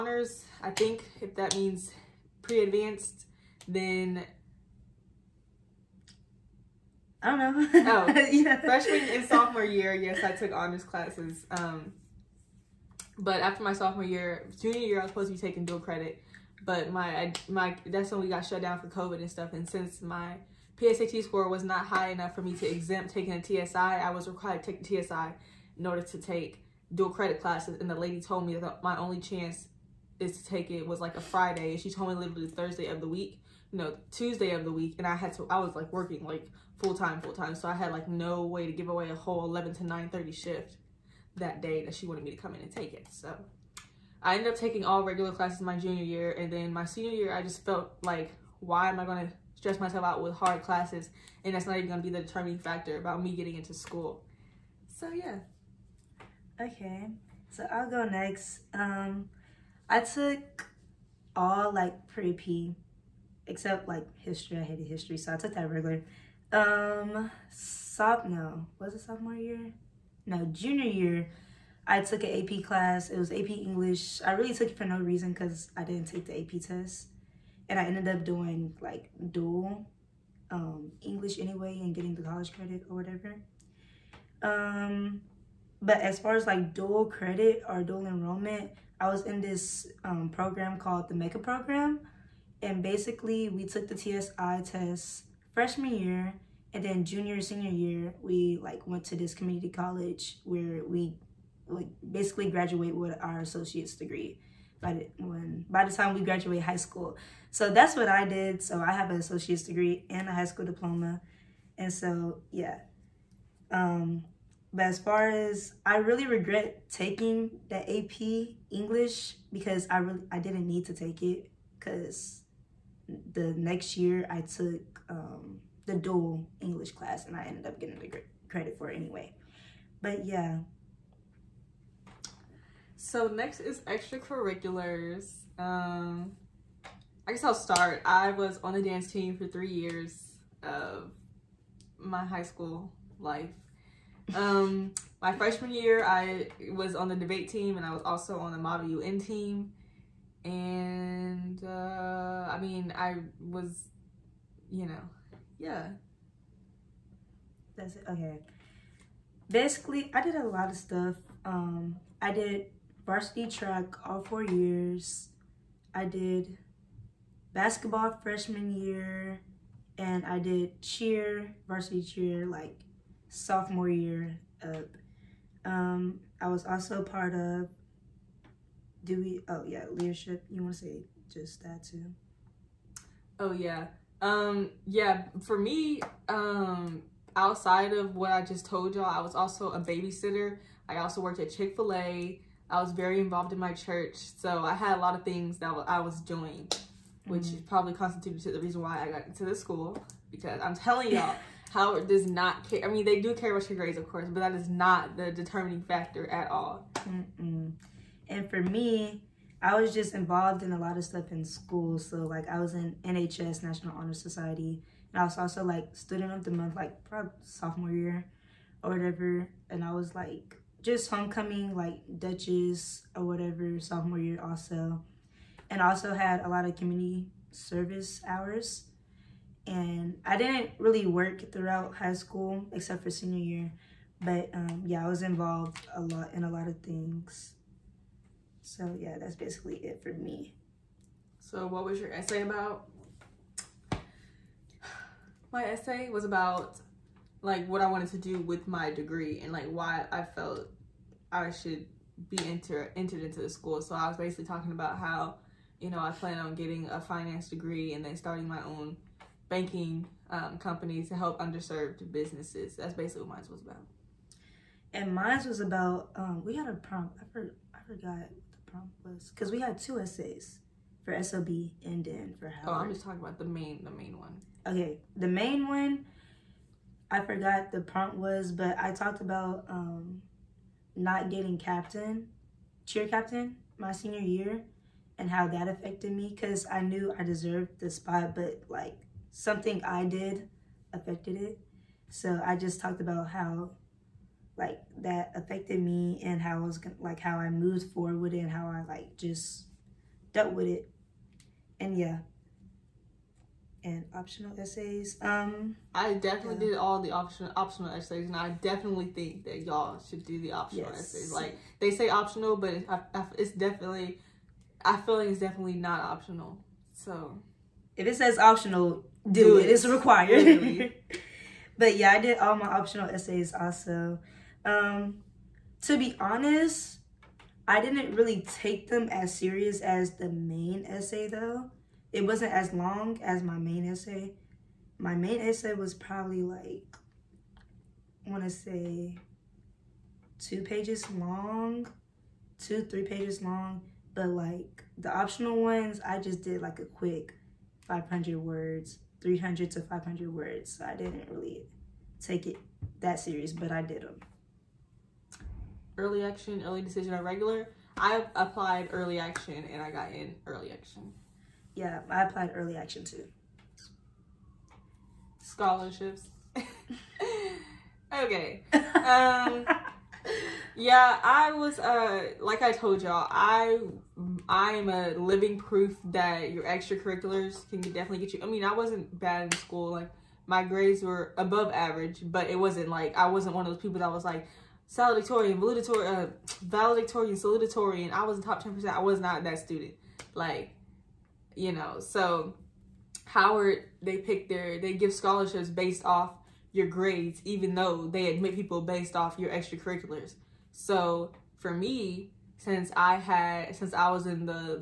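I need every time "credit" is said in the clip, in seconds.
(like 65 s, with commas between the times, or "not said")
15 s, 27 s, 82 s, 87 s, 128 s.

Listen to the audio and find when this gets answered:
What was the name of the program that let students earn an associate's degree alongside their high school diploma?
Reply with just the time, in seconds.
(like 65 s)
91 s.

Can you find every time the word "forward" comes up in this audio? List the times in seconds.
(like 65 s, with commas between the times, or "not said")
297 s.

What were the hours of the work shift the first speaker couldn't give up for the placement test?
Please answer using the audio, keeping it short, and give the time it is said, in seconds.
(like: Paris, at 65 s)
11 to 9:30, at 39 s.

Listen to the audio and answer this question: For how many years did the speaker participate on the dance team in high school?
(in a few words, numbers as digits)
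3.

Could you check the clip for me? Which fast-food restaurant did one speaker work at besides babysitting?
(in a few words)
Chick fil A.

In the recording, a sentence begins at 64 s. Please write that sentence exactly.
I hated history, so I took that regular.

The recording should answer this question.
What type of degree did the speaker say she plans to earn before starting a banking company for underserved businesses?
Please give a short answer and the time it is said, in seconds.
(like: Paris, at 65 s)
finance, at 257 s.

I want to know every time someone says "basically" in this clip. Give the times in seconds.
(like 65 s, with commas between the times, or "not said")
92 s, 102 s, 159 s, 239 s, 254 s, 262 s.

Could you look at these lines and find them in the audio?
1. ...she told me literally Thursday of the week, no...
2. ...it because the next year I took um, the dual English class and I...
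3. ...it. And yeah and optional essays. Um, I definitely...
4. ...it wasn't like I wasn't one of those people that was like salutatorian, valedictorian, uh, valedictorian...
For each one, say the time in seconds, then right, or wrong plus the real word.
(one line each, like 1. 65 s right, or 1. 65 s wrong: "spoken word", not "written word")
1. 31 s right
2. 121 s right
3. 300 s right
4. 382 s right.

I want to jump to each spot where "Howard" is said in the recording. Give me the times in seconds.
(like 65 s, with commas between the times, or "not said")
201 s, 272 s, 393 s.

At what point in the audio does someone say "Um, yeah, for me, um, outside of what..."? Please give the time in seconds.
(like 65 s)
184 s.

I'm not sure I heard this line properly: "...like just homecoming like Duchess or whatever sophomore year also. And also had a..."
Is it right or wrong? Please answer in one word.
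right.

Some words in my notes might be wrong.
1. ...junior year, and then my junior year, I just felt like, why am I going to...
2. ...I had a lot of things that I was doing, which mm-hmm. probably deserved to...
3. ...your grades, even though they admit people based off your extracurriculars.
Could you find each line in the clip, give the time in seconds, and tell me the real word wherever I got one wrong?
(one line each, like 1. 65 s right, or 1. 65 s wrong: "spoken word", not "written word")
1. 45 s wrong: "senior", not "junior"
2. 194 s wrong: "constituted", not "deserved"
3. 396 s right.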